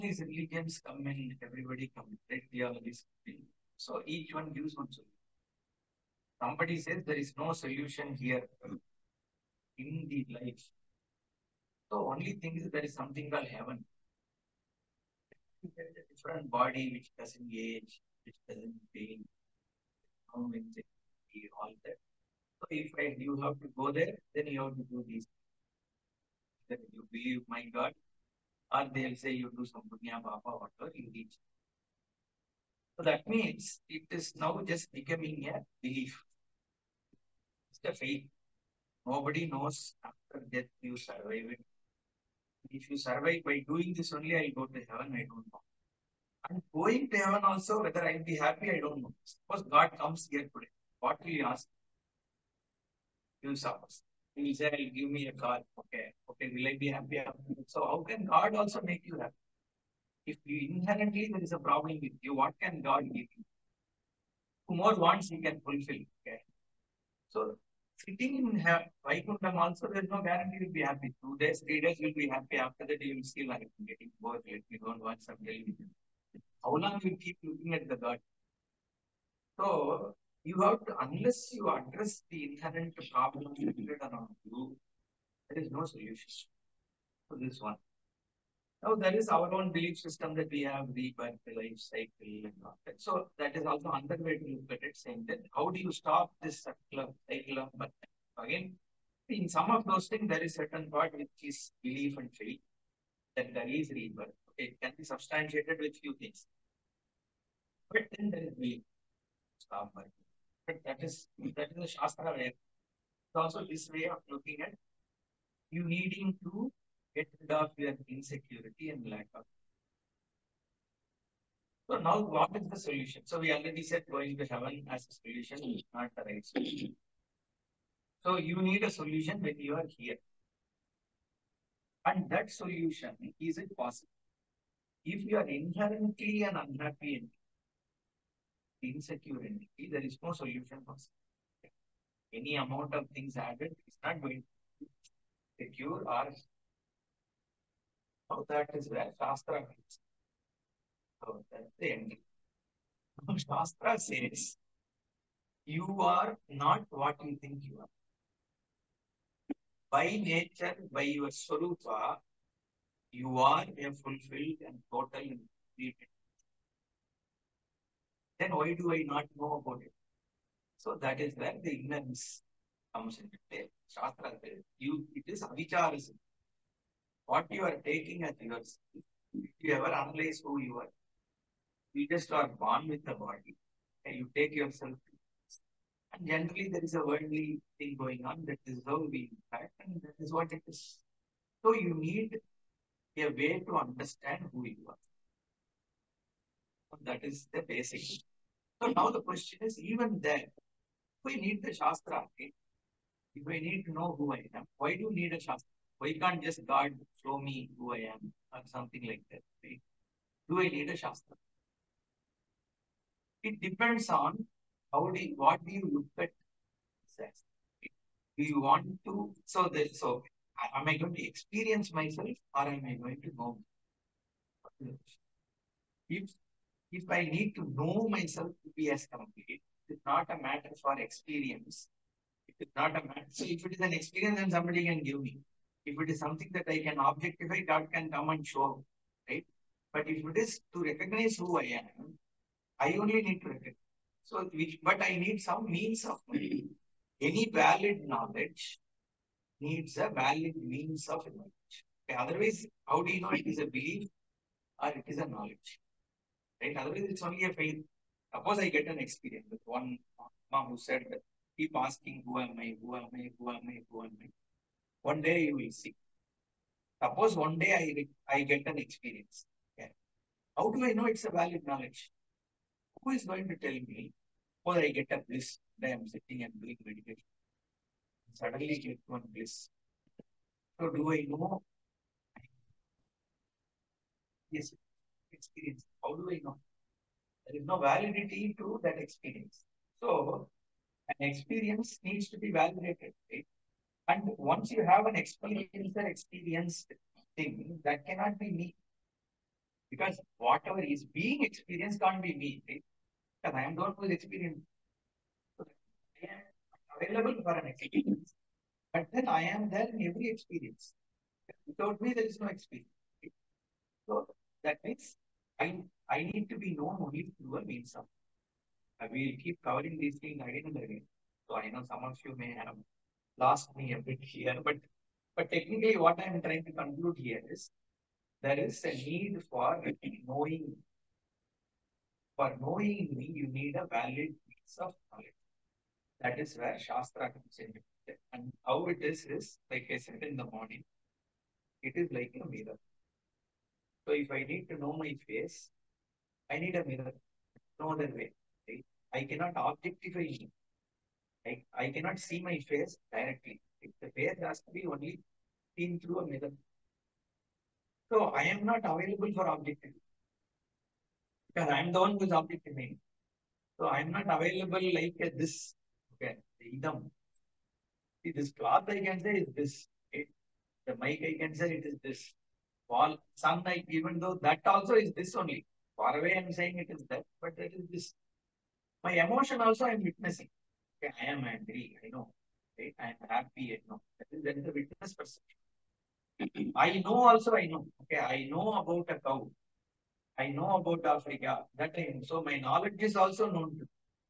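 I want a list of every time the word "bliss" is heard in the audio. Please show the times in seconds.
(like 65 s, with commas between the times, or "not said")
275 s, 279 s.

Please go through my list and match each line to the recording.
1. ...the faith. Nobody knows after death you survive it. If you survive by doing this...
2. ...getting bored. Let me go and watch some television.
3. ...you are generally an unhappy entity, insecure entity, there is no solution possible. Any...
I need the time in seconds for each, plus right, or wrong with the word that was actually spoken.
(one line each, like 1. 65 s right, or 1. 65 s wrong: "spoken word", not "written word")
1. 37 s right
2. 73 s right
3. 135 s wrong: "inherently", not "generally".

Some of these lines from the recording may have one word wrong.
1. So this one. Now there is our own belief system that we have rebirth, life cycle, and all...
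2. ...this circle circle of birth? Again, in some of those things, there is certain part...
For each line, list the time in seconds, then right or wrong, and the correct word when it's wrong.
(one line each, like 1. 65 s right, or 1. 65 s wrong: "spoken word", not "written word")
1. 87 s right
2. 96 s wrong: "cycle", not "circle".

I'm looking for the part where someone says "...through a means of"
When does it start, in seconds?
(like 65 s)
317 s.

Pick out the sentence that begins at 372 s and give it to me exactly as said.
Wall, some night even though that also is this only.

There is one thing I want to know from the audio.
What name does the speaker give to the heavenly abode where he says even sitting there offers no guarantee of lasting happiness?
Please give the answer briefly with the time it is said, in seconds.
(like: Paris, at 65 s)
Vaikuntham, at 69 s.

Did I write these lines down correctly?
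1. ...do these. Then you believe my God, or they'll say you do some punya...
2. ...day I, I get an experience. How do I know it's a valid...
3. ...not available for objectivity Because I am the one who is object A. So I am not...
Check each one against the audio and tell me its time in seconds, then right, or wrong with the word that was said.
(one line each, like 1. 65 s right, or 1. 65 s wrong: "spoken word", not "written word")
1. 24 s right
2. 267 s right
3. 358 s right.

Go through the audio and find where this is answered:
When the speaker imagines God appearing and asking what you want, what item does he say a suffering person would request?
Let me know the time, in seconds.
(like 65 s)
54 s.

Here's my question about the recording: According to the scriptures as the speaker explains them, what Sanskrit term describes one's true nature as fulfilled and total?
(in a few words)
Swarupa.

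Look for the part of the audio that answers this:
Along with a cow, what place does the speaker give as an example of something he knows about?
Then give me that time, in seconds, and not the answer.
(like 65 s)
391 s.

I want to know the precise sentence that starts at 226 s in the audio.
If if I need to know myself to be as complete, it's not a matter for experience.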